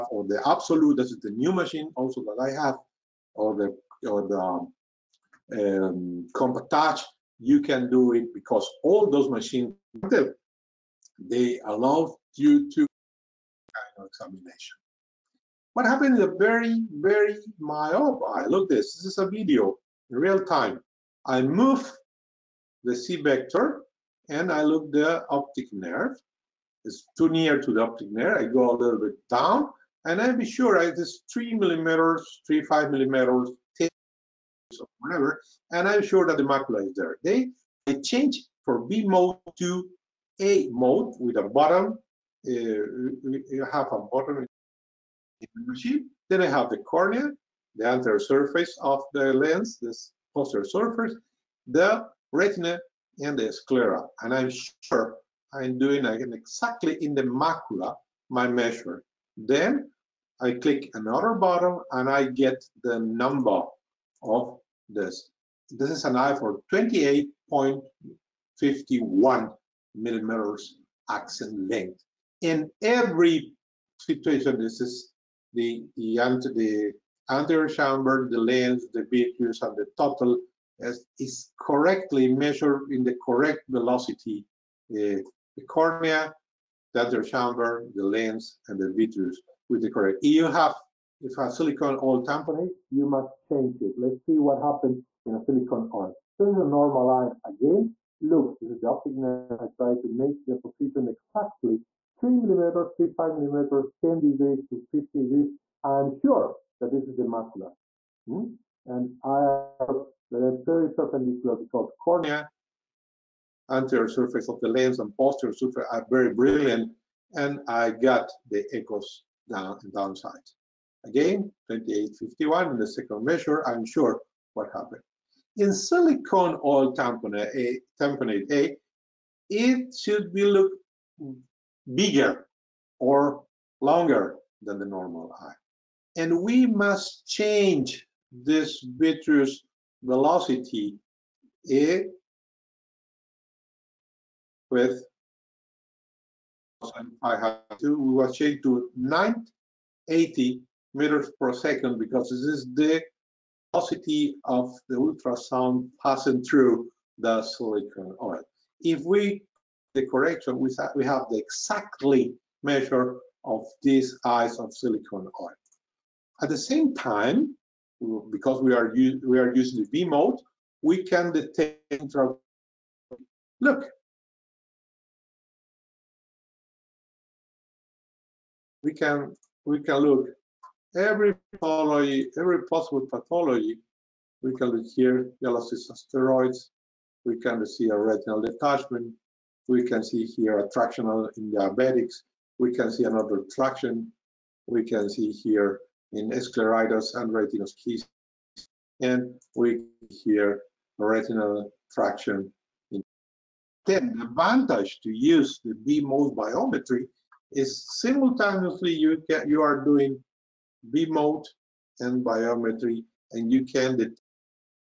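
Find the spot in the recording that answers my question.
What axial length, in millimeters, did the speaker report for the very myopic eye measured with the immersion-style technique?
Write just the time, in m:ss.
1:06.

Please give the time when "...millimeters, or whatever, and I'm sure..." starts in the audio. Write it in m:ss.
0:32.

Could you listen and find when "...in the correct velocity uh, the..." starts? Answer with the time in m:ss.
1:22.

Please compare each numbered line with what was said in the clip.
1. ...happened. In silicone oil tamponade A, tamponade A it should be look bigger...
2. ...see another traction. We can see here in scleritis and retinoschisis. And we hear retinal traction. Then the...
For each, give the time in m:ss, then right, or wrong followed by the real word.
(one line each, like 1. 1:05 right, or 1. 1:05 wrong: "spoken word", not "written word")
1. 2:04 right
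2. 3:12 right.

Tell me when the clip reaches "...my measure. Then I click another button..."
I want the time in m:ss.
0:58.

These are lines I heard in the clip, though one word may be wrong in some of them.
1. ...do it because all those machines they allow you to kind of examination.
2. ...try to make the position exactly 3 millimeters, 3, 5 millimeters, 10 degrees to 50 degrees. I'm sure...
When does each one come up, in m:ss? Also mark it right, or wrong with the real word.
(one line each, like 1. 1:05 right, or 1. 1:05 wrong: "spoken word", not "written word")
1. 0:07 right
2. 1:39 right.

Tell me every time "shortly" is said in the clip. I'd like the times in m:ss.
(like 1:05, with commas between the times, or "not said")
not said.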